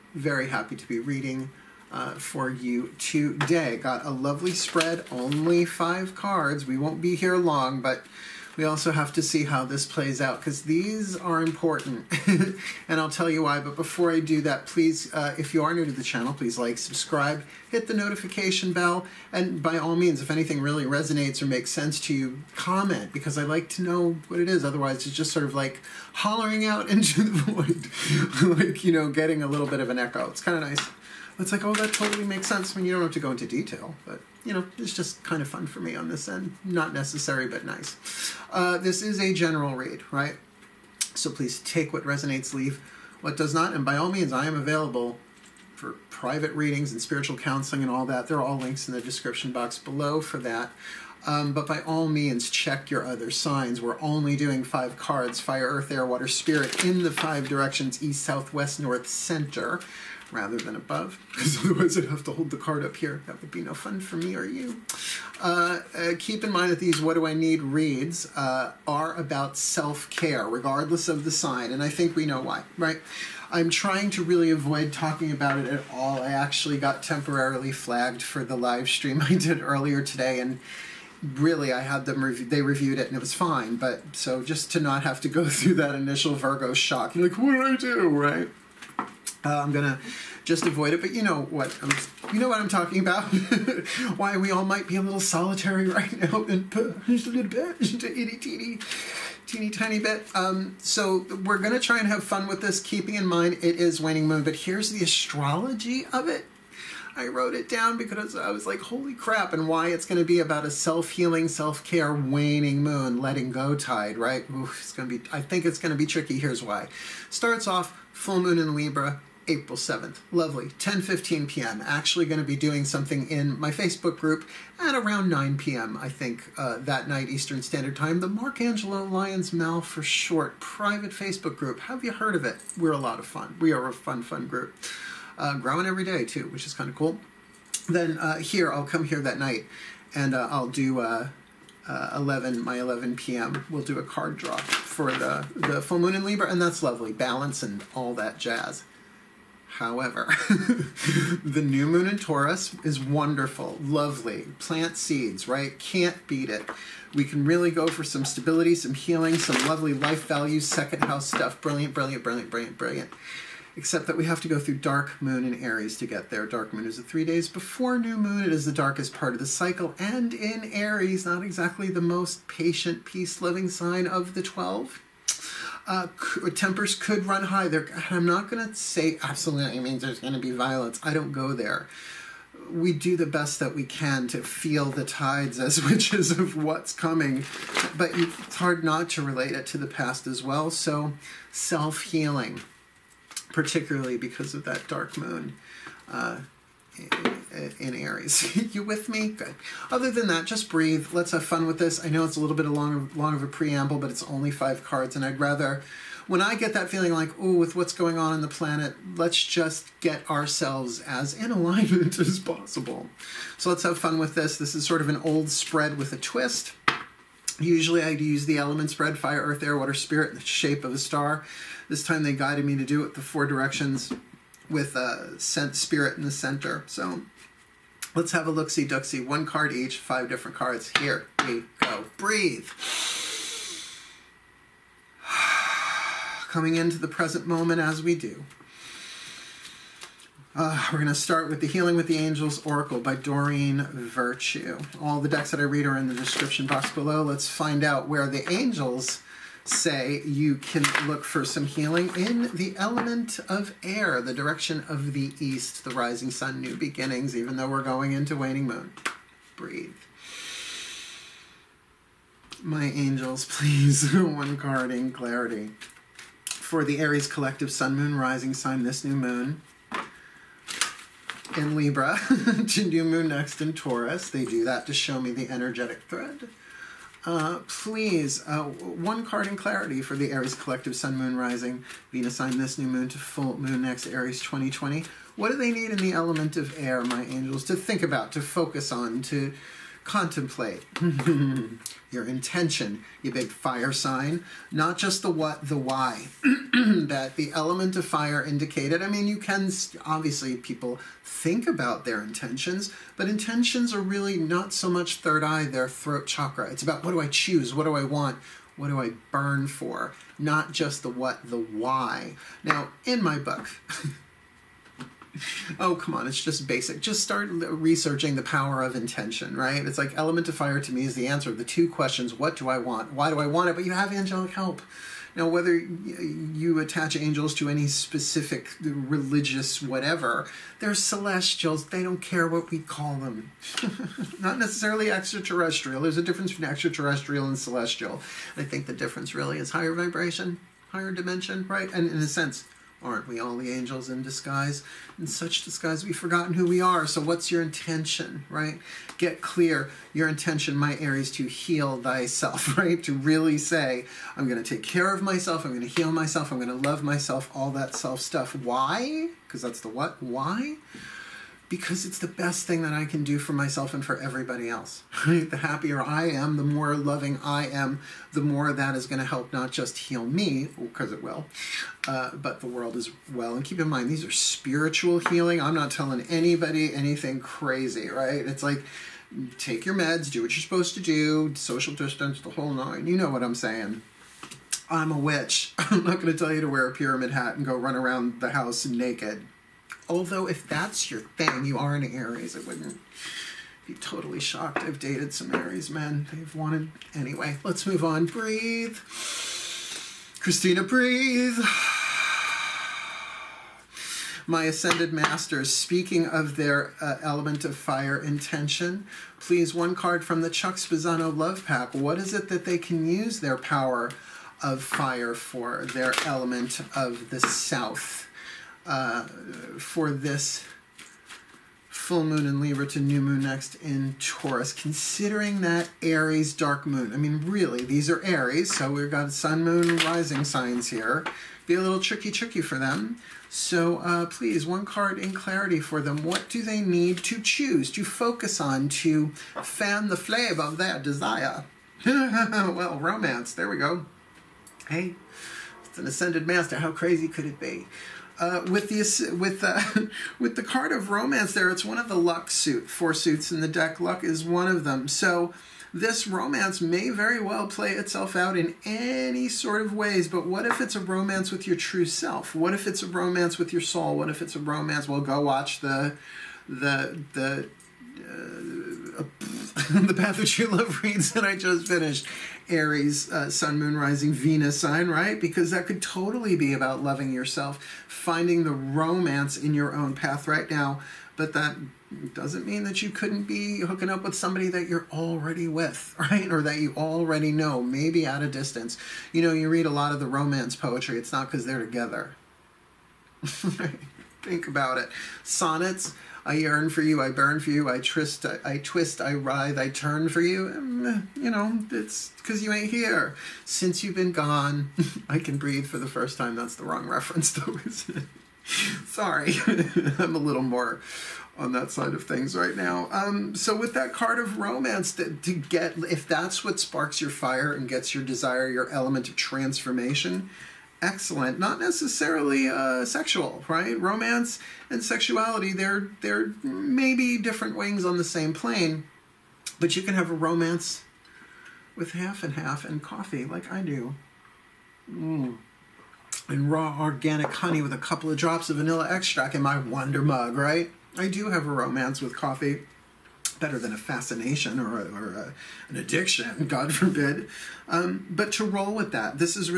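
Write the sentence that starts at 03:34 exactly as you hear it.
This is sort of an old spread with a twist.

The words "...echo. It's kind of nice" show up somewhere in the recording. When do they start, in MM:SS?
00:29.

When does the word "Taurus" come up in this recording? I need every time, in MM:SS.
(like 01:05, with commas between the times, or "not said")
02:32, 04:33, 07:04.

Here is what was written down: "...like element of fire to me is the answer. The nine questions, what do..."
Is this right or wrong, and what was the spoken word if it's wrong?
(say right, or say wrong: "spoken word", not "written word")
wrong: "two", not "nine".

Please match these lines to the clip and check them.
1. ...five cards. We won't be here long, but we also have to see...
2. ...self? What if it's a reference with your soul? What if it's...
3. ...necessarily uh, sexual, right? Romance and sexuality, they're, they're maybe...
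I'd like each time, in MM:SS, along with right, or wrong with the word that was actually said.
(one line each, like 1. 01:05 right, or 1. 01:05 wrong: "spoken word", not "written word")
1. 00:05 right
2. 07:42 wrong: "romance", not "reference"
3. 08:41 right.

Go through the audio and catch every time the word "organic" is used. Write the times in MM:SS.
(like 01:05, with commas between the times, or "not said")
08:56.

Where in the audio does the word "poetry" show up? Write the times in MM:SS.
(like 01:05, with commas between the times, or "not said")
08:10.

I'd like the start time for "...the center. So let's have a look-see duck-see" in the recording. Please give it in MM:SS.
03:46.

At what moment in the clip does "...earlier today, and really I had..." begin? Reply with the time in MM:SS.
01:19.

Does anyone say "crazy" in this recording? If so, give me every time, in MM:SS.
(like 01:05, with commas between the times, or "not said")
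06:17, 07:26.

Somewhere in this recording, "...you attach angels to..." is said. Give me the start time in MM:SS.
05:25.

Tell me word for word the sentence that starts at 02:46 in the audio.
Dark moon is the three days before new moon.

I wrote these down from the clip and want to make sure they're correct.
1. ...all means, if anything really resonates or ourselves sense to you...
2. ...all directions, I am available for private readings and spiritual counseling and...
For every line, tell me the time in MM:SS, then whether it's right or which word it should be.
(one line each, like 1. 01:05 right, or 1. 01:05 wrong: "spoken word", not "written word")
1. 00:19 wrong: "makes", not "ourselves"
2. 00:43 wrong: "means", not "directions".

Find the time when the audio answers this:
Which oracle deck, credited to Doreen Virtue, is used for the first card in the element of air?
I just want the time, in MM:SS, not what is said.
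04:01.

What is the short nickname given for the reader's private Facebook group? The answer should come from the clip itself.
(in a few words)
Mal.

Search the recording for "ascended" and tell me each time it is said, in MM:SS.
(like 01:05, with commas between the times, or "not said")
06:44, 07:26.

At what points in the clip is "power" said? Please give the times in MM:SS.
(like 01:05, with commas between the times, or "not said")
05:18, 06:53.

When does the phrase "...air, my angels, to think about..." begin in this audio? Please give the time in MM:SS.
04:46.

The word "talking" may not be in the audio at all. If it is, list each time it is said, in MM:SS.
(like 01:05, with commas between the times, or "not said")
01:14, 01:32.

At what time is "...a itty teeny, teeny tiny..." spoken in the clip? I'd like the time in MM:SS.
01:38.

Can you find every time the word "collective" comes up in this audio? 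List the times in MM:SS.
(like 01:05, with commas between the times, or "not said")
04:27, 04:40.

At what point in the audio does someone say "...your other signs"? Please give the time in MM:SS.
00:52.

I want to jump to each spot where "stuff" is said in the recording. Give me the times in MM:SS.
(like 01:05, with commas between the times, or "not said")
02:41, 05:58.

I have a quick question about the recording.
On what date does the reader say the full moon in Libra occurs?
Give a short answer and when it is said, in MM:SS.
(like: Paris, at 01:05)
April 7th, at 01:59.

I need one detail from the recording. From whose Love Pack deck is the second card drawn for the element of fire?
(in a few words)
Chuck Spezzano.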